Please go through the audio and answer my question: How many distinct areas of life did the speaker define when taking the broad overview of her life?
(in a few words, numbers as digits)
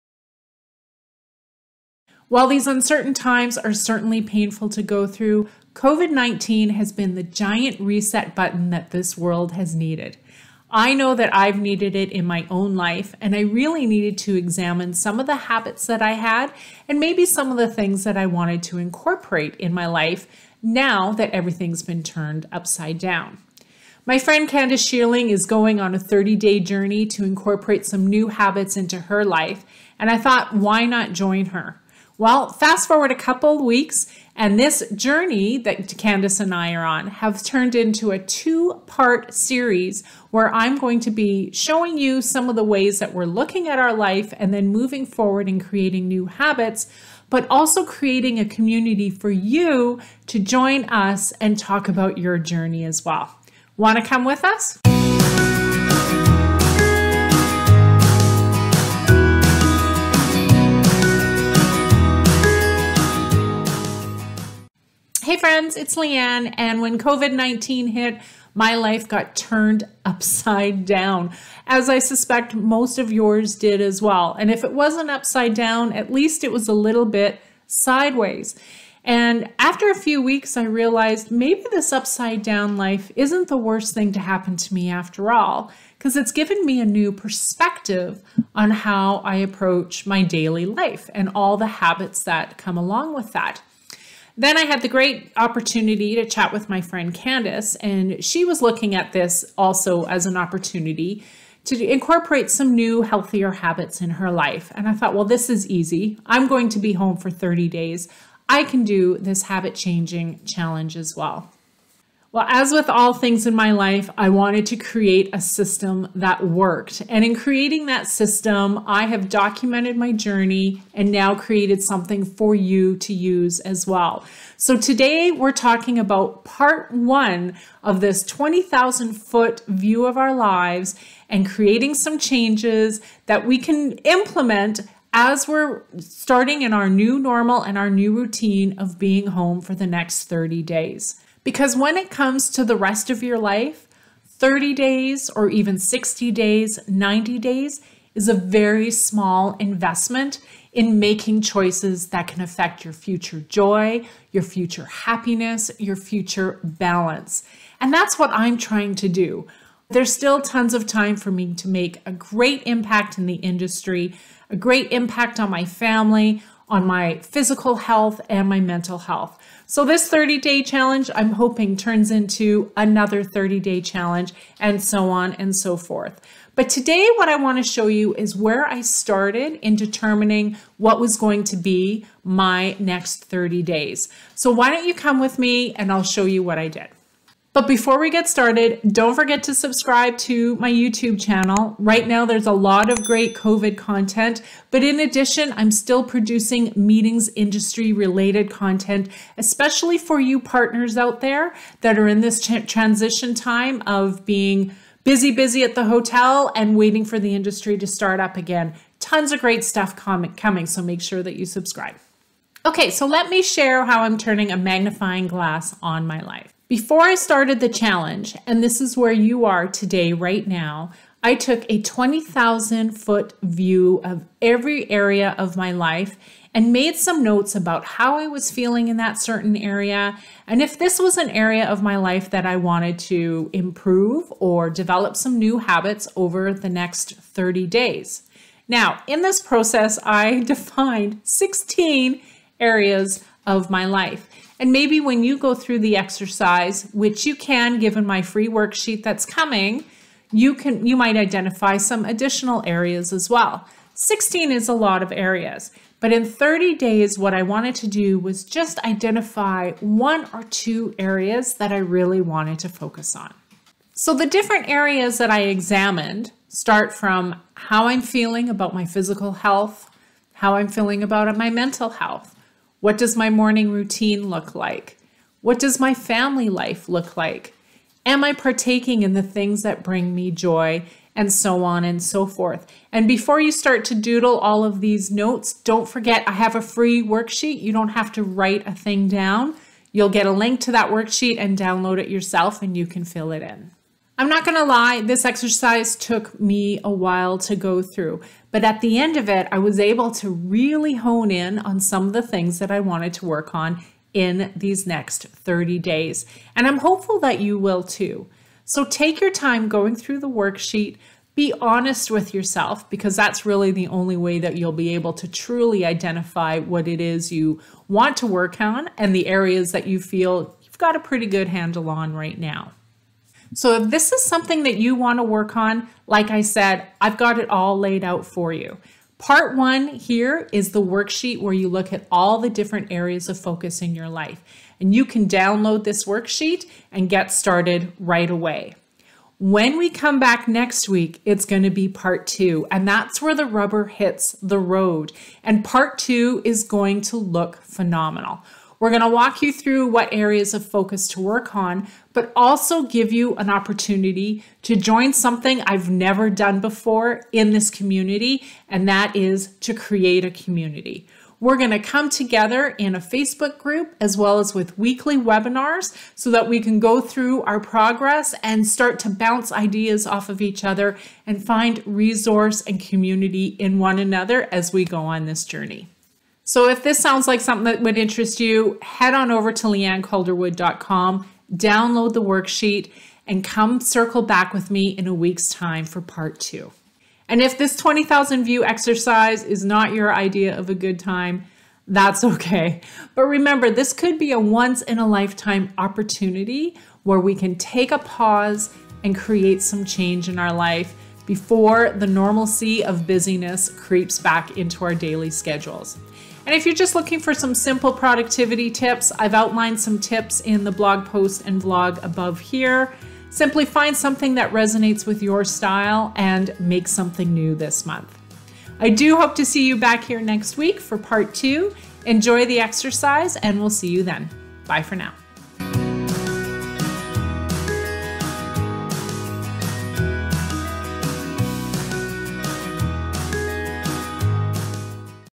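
16.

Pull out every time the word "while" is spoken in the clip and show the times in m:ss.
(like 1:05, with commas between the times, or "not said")
0:02, 4:56.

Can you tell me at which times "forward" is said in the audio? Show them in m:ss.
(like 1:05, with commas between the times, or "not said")
0:32, 0:45.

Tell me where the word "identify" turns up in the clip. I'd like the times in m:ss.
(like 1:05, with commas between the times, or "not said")
4:11, 4:18, 5:15.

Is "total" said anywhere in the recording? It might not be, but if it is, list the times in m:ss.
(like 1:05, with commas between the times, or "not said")
not said.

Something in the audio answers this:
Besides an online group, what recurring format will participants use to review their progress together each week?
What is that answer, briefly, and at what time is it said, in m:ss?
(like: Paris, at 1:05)
weekly webinars, at 6:04.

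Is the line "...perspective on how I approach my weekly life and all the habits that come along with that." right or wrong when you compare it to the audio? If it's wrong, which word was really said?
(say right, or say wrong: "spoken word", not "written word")
wrong: "daily", not "weekly".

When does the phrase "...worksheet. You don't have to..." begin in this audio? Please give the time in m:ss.
4:47.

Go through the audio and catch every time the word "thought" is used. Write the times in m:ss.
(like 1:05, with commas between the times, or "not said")
0:30, 1:44.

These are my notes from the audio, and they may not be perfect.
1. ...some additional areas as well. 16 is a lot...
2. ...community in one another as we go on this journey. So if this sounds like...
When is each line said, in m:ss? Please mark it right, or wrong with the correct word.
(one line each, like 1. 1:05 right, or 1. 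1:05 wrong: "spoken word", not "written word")
1. 4:11 right
2. 6:12 right.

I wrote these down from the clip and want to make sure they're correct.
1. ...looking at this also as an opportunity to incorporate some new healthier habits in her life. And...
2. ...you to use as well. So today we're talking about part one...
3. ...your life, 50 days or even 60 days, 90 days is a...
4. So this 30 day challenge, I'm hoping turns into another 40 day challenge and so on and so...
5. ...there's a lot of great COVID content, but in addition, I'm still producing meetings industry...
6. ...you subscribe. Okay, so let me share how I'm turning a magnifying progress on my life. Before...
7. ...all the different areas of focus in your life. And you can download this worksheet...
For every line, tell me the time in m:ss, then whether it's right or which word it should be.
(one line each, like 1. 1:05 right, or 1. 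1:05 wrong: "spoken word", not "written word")
1. 1:38 right
2. 2:02 right
3. 2:23 wrong: "30", not "50"
4. 2:49 wrong: "30", not "40"
5. 3:12 right
6. 3:31 wrong: "glass", not "progress"
7. 5:32 right.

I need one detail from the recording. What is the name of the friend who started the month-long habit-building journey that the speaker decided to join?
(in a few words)
Candace Shearling.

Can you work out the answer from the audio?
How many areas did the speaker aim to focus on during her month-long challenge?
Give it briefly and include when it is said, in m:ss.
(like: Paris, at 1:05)
one or two, at 4:19.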